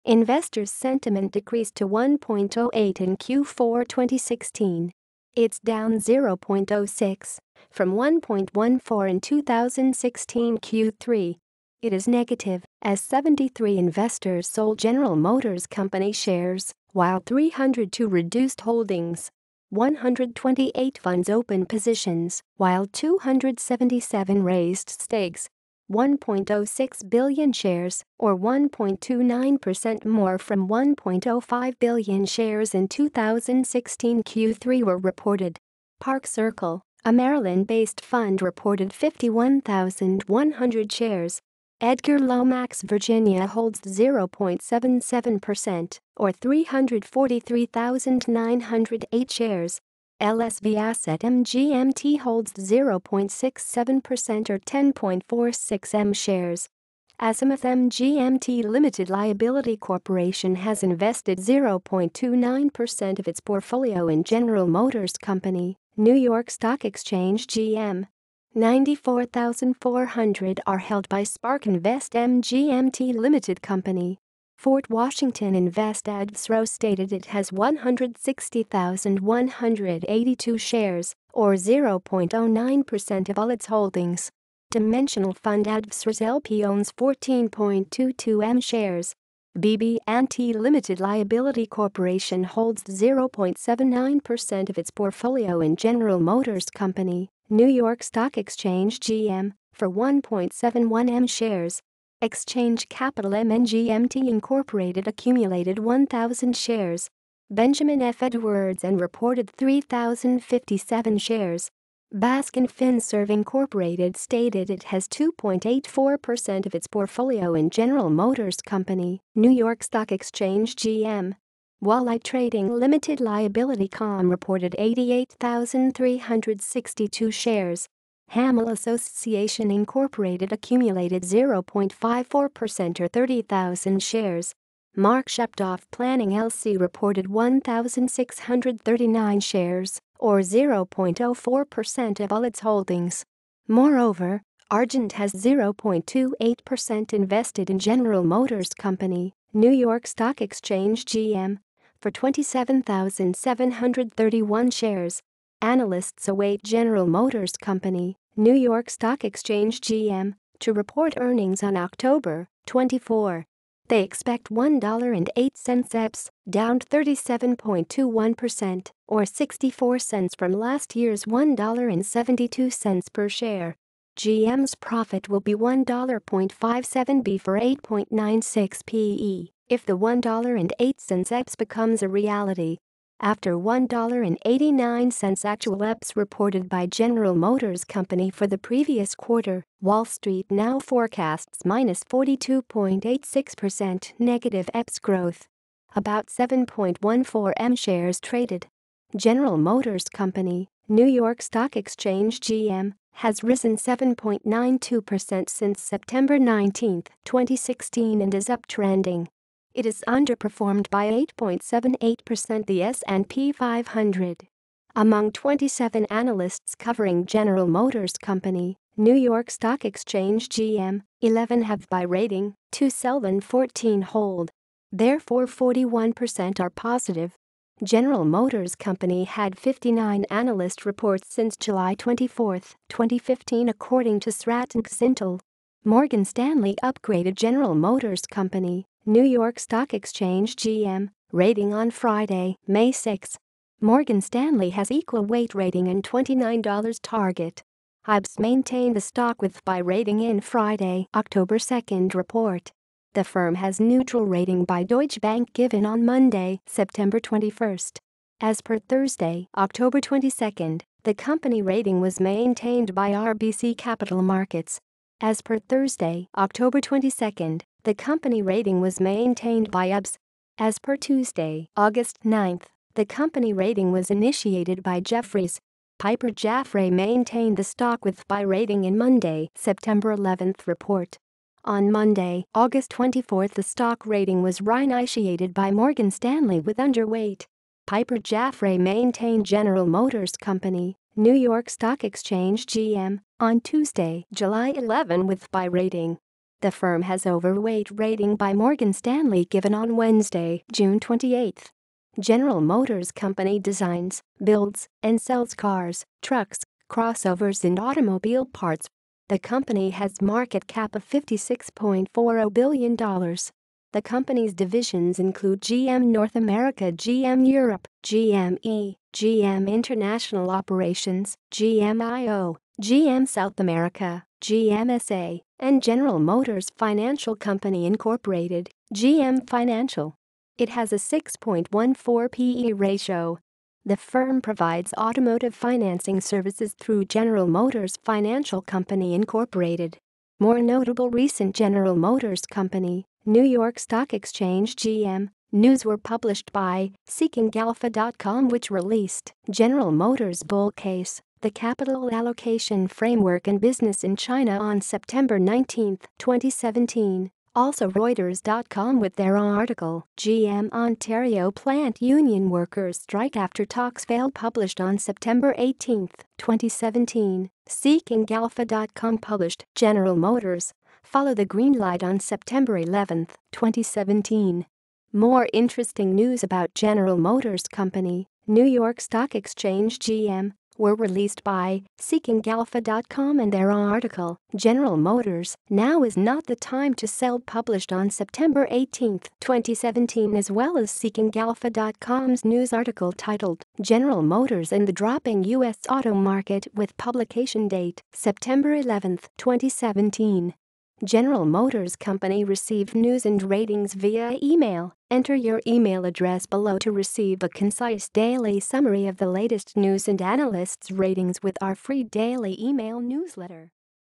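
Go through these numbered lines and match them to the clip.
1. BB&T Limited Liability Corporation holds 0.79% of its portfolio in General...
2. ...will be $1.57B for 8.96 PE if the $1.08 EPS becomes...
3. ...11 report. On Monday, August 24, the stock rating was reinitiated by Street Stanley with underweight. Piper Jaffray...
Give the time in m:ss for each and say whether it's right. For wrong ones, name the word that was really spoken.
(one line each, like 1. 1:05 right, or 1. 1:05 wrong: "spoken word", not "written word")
1. 1:29 right
2. 2:55 right
3. 4:40 wrong: "Morgan", not "Street".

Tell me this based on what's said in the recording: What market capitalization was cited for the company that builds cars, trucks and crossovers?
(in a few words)
$56.40 billion.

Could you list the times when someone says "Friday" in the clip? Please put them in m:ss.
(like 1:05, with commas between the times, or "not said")
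4:01, 4:10.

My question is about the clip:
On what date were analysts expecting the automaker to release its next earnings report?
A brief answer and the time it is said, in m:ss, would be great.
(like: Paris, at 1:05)
October 24, at 2:41.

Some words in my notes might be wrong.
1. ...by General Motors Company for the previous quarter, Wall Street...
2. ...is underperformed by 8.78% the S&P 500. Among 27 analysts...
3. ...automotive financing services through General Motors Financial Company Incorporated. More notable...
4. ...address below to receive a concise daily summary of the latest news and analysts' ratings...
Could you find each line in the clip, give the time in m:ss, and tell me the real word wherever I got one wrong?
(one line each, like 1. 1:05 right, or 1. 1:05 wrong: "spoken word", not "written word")
1. 3:06 right
2. 3:29 right
3. 5:34 right
4. 6:46 right.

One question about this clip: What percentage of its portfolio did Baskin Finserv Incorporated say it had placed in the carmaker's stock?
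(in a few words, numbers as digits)
2.84%.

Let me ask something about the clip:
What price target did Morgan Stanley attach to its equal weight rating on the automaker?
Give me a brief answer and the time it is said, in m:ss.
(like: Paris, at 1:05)
$29, at 4:06.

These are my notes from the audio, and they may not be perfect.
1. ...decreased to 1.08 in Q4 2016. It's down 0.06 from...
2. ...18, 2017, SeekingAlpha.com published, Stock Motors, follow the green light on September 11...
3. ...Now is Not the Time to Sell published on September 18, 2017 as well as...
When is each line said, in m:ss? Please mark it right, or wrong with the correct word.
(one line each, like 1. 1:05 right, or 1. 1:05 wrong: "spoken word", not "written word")
1. 0:01 right
2. 6:05 wrong: "General", not "Stock"
3. 6:25 right.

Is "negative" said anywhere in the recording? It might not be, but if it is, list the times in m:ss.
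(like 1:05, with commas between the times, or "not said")
0:12, 3:14.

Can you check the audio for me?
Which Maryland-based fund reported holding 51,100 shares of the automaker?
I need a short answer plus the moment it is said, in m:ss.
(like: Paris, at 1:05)
Park Circle, at 0:35.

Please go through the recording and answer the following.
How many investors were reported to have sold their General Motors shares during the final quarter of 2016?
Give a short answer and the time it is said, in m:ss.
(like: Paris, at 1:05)
73, at 0:12.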